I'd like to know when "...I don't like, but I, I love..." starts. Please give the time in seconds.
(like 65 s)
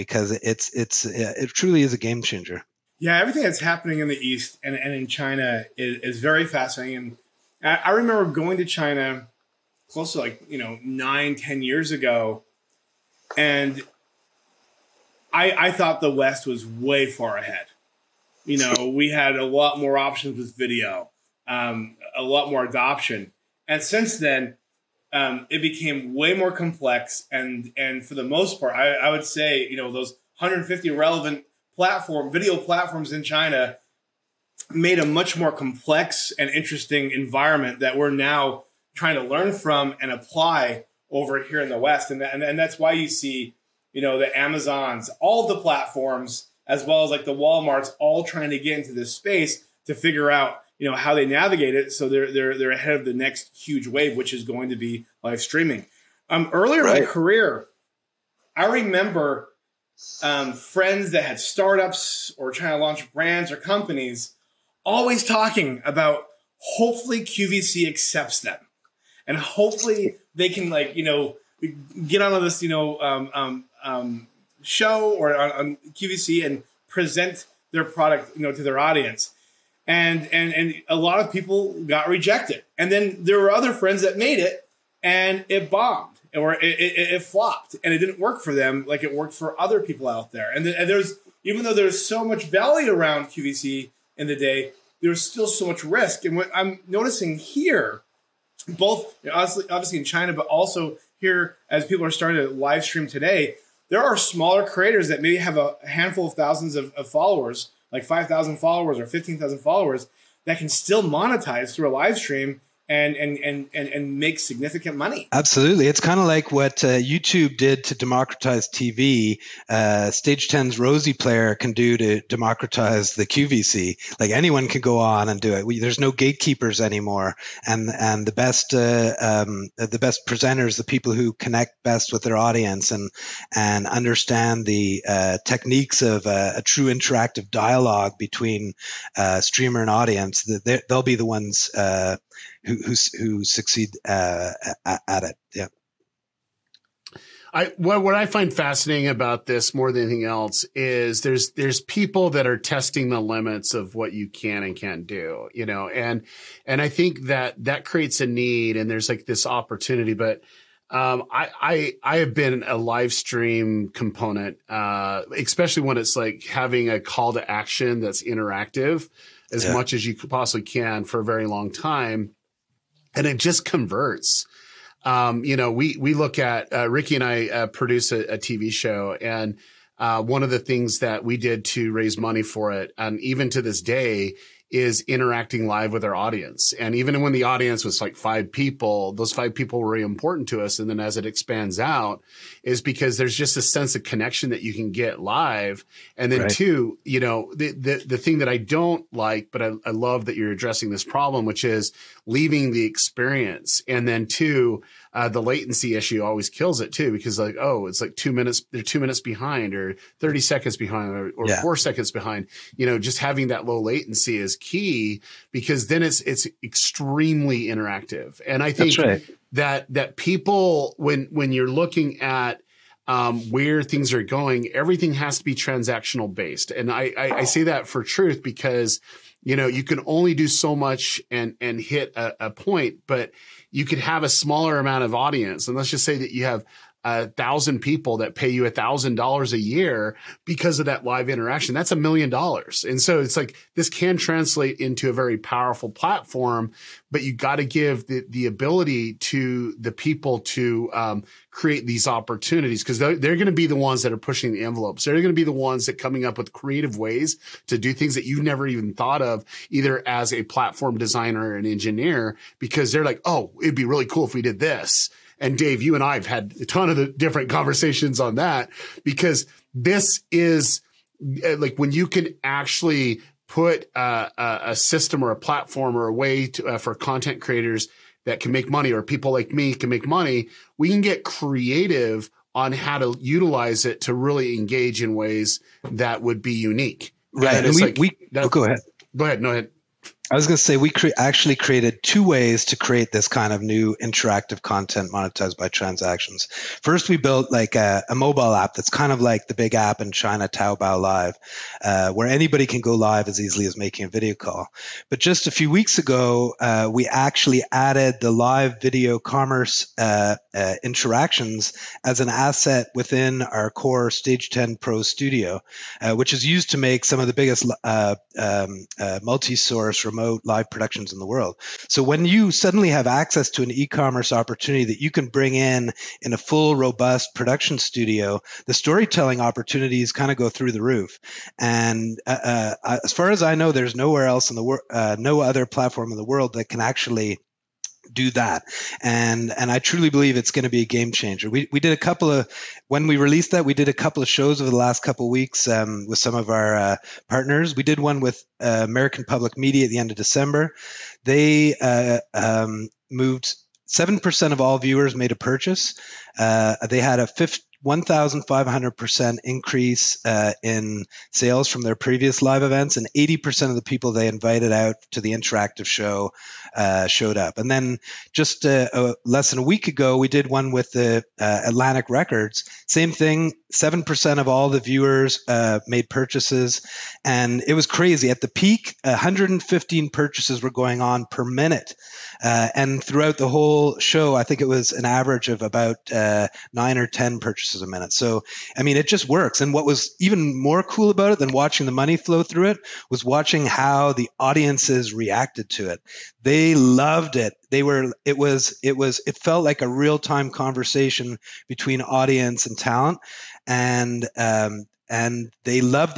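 198 s.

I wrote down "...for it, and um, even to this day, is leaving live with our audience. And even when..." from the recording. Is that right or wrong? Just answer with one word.
wrong.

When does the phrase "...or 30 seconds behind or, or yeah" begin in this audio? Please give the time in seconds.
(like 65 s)
209 s.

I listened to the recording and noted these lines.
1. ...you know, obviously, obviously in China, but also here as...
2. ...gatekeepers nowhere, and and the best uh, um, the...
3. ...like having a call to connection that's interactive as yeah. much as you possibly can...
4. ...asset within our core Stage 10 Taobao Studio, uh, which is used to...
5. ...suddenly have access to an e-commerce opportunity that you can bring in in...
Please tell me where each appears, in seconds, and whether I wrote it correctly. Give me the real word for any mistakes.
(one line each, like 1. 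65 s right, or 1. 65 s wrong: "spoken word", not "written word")
1. 99 s right
2. 126 s wrong: "anymore", not "nowhere"
3. 166 s wrong: "action", not "connection"
4. 312 s wrong: "Pro", not "Taobao"
5. 322 s right.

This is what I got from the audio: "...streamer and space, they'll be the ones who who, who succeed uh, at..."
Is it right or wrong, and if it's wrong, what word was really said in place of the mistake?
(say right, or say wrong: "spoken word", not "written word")
wrong: "audience", not "space".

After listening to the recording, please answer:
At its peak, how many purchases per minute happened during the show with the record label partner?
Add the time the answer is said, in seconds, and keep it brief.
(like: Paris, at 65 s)
115, at 379 s.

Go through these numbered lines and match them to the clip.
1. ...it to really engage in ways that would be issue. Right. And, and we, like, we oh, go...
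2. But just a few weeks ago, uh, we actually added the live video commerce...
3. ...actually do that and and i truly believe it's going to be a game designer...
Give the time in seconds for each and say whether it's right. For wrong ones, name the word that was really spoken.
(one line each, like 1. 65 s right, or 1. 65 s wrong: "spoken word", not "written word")
1. 283 s wrong: "unique", not "issue"
2. 305 s right
3. 336 s wrong: "changer", not "designer".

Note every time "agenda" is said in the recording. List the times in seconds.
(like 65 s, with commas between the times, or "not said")
not said.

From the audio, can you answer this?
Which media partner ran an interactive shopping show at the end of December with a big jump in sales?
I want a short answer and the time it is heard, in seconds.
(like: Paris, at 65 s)
American Public Media, at 348 s.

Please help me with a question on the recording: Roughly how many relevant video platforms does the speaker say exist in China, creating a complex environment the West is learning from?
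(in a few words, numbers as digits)
150.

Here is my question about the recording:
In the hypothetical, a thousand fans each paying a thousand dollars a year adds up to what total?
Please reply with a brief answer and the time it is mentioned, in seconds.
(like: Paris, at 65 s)
a million dollars, at 241 s.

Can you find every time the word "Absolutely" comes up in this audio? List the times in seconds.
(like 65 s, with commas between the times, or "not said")
115 s.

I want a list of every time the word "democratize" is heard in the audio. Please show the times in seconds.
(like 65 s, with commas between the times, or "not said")
117 s, 122 s.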